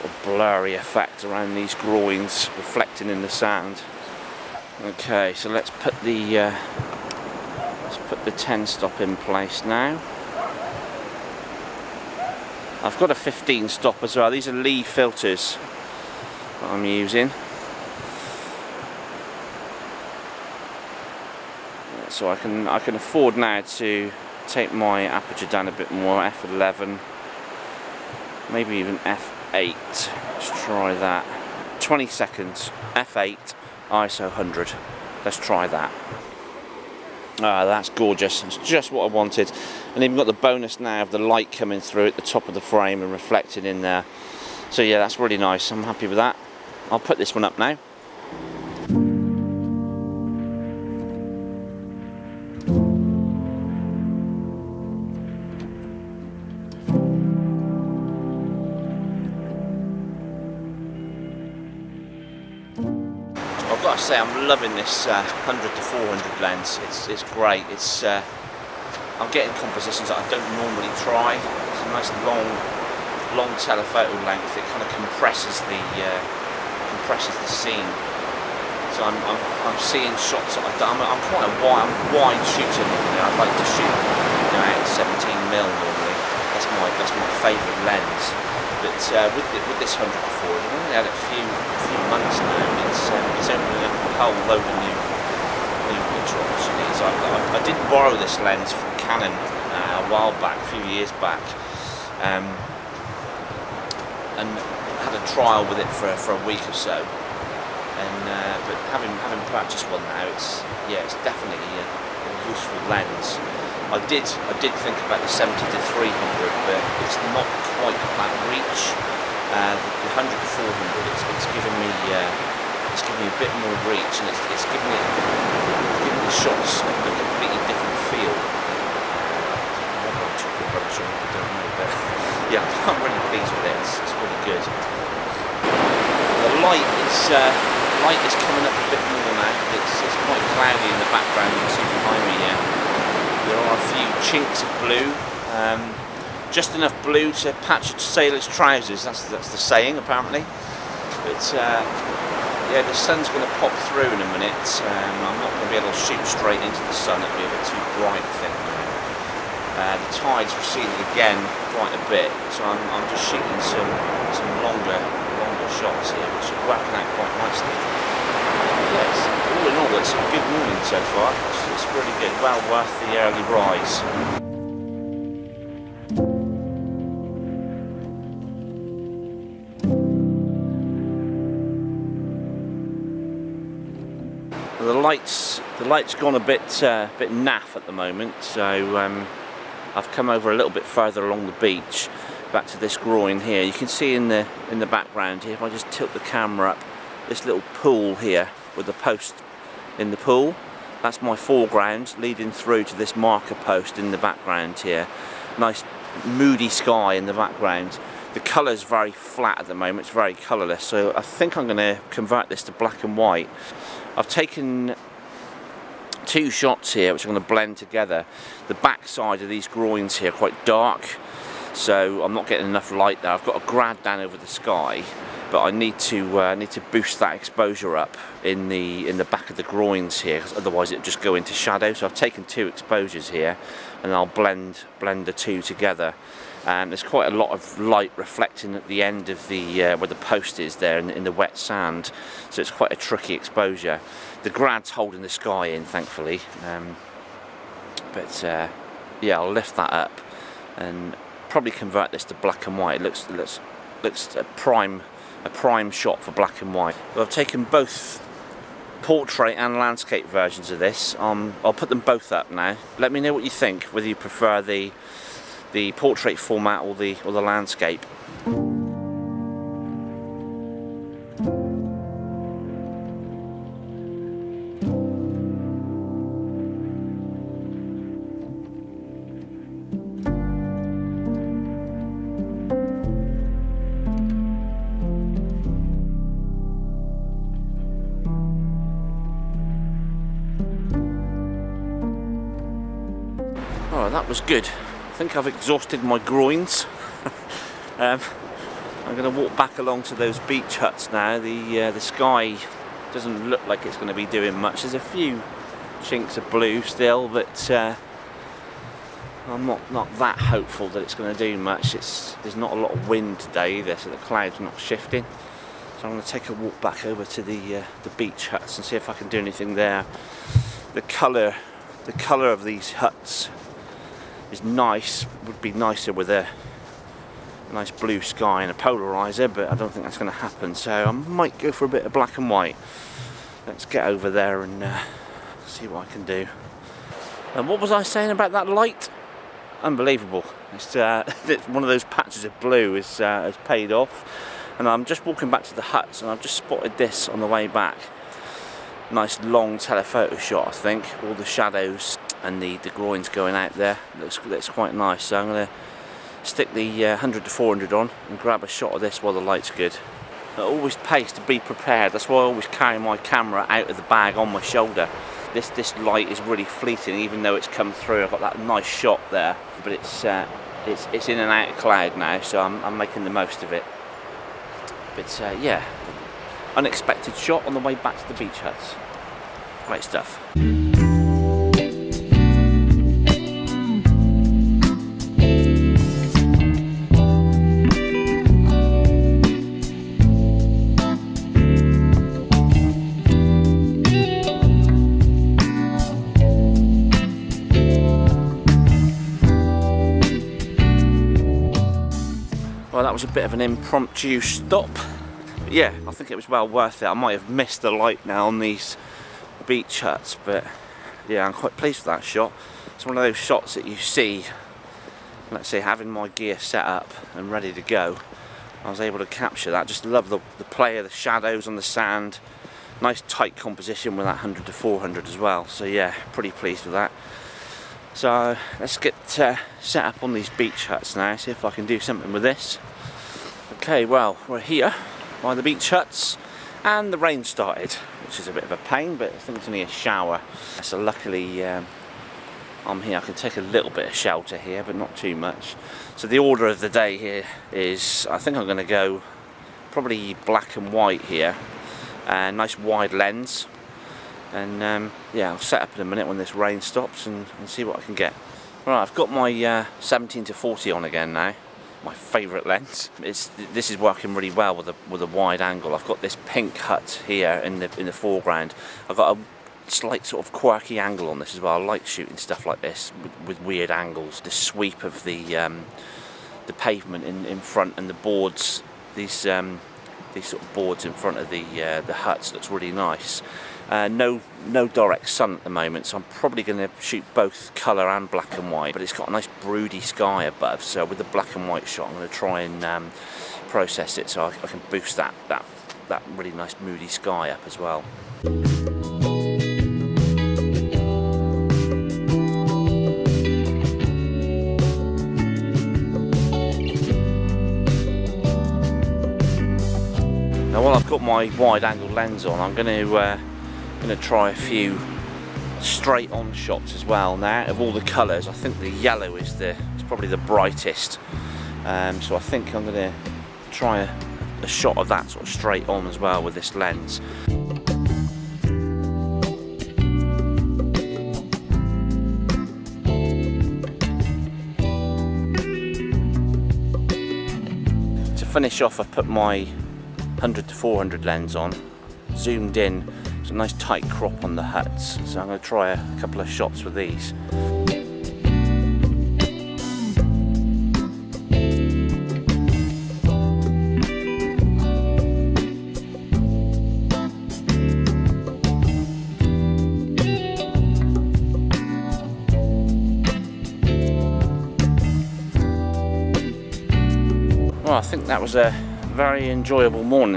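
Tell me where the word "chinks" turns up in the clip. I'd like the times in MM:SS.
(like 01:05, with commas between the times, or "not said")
02:24, 05:06.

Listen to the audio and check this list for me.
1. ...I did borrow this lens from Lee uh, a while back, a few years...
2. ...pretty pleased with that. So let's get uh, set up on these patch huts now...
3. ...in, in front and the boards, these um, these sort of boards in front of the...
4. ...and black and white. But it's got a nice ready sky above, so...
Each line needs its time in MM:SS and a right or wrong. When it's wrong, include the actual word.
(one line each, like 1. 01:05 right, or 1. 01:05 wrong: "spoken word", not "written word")
1. 01:37 wrong: "Canon", not "Lee"
2. 07:06 wrong: "beach", not "patch"
3. 07:57 right
4. 08:08 wrong: "broody", not "ready".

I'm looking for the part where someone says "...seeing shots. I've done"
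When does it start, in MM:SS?
01:19.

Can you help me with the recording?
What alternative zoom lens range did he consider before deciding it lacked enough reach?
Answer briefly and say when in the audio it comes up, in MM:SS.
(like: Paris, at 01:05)
70 to 300, at 01:55.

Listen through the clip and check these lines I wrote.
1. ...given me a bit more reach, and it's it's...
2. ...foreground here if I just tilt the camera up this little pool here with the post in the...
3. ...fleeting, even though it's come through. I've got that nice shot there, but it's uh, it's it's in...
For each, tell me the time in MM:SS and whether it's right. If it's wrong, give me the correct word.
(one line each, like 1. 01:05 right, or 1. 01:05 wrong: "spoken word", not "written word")
1. 02:03 right
2. 03:14 wrong: "background", not "foreground"
3. 06:06 right.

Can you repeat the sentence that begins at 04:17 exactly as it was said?
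But I've taken both portrait and landscape versions of this.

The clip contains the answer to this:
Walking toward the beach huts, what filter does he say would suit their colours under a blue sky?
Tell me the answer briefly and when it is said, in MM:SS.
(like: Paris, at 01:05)
Polarizer, at 05:28.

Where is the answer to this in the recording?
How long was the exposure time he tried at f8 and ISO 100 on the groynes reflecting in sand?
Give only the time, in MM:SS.
00:31.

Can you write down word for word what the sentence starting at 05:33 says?
Let's get over there and uh, see what I can do.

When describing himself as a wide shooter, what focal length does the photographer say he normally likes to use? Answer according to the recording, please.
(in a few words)
17mm.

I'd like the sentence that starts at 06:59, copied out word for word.
Just love the, the play of the shadows on the sand.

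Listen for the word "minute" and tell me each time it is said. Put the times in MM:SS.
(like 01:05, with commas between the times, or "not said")
02:34, 07:36.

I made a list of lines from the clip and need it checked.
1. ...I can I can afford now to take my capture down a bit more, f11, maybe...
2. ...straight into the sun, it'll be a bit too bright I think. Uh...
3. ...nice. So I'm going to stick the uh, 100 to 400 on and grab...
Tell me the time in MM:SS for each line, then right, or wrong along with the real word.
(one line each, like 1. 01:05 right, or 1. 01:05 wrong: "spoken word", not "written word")
1. 00:22 wrong: "aperture", not "capture"
2. 02:36 right
3. 05:54 right.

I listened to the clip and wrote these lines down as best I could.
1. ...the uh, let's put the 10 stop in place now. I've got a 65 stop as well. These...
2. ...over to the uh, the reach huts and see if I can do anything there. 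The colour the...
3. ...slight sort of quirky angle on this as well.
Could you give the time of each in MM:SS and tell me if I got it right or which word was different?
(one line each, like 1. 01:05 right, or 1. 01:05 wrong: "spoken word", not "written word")
1. 00:06 wrong: "15", not "65"
2. 05:17 wrong: "beach", not "reach"
3. 07:49 right.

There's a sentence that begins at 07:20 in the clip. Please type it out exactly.
So luckily um, I'm here, I can take a little bit of shelter here, but not too much.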